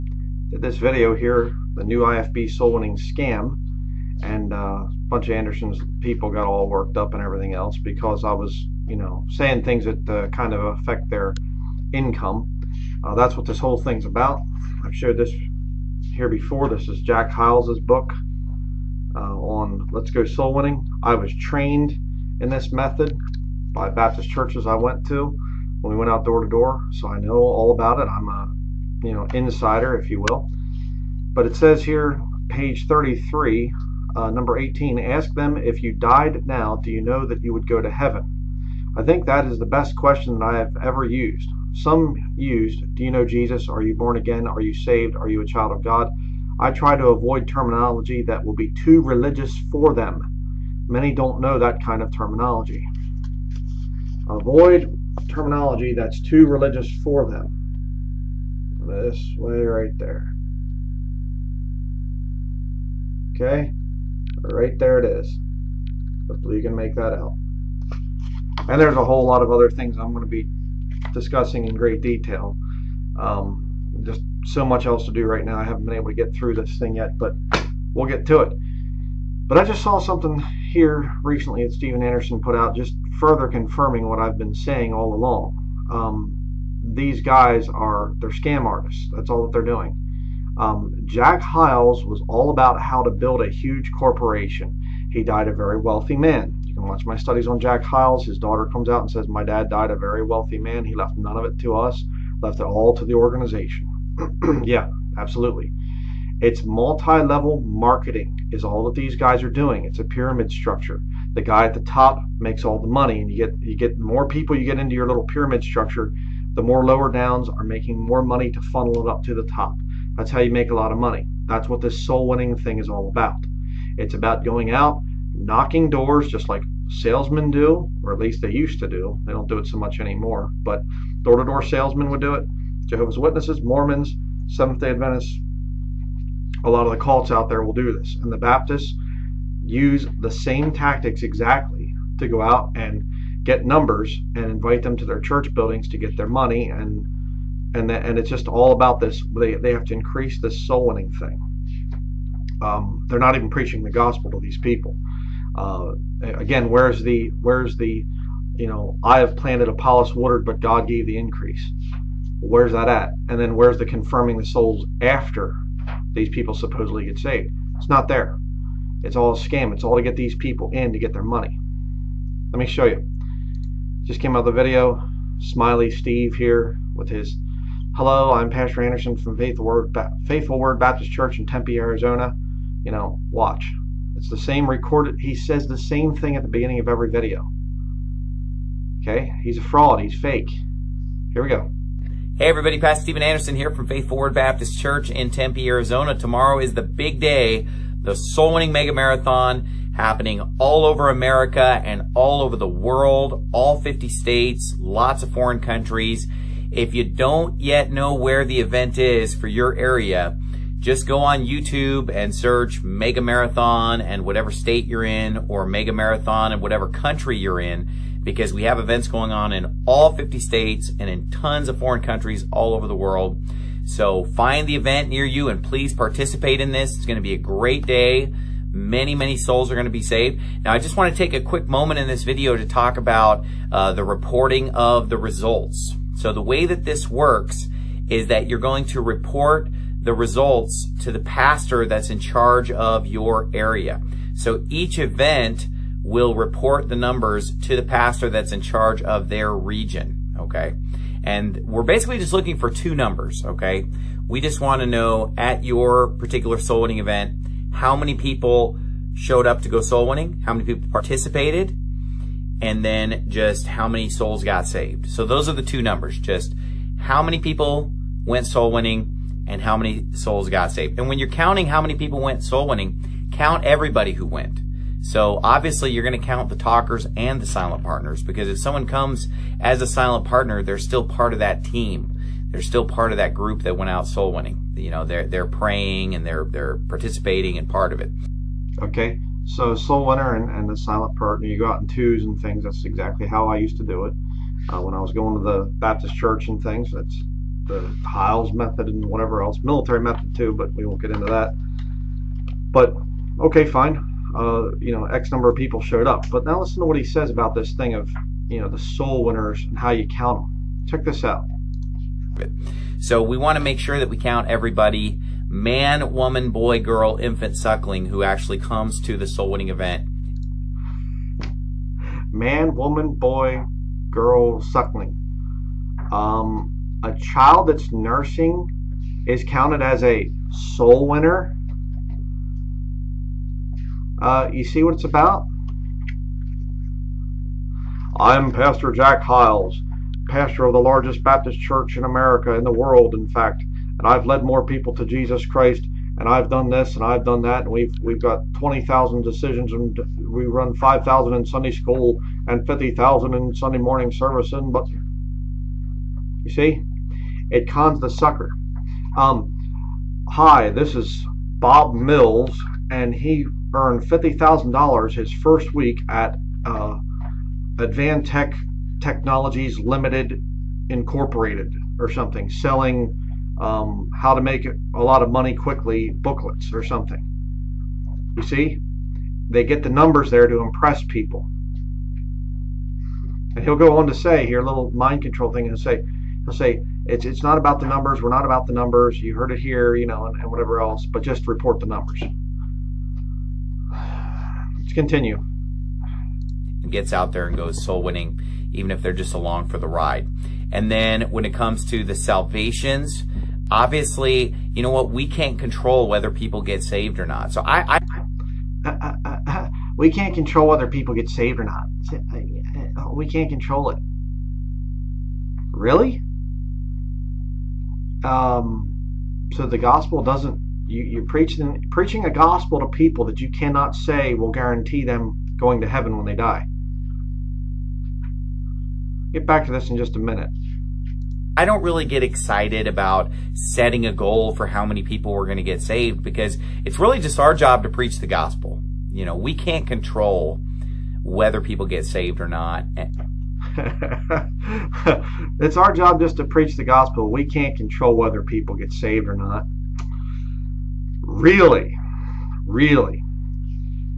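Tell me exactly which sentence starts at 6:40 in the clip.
And then when it comes to the salvations, obviously, you know what?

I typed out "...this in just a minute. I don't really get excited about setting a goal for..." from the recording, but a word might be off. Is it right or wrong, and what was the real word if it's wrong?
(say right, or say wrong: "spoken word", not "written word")
right.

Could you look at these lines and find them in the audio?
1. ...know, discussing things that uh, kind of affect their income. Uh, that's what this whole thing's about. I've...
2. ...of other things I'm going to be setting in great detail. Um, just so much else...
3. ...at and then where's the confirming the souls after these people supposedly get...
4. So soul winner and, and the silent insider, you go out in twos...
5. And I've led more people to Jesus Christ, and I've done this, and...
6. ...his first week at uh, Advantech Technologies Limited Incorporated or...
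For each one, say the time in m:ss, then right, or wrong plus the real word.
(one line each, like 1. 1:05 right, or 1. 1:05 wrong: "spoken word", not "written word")
1. 0:08 wrong: "saying", not "discussing"
2. 1:09 wrong: "discussing", not "setting"
3. 2:42 right
4. 4:49 wrong: "partner", not "insider"
5. 5:43 right
6. 6:05 right.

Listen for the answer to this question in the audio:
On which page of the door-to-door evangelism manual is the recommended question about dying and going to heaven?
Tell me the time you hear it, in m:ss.
0:32.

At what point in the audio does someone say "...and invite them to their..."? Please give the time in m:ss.
2:24.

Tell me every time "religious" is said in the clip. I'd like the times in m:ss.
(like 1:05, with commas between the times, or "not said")
0:49, 0:56.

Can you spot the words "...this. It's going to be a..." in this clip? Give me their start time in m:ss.
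3:46.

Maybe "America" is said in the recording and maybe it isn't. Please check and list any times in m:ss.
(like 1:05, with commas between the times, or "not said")
3:21, 5:42.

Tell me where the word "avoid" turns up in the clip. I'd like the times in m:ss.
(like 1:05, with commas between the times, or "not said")
0:47, 0:54.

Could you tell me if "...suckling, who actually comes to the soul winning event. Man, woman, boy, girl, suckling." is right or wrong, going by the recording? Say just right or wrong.
right.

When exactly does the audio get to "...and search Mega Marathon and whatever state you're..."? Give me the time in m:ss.
3:32.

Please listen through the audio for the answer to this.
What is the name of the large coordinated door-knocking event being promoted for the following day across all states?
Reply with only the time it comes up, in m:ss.
3:18.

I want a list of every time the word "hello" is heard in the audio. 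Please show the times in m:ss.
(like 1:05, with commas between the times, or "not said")
2:57.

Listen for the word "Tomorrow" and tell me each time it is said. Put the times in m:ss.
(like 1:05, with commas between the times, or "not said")
3:16.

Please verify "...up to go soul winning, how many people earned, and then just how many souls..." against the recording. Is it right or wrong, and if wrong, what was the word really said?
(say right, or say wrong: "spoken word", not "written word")
wrong: "participated", not "earned".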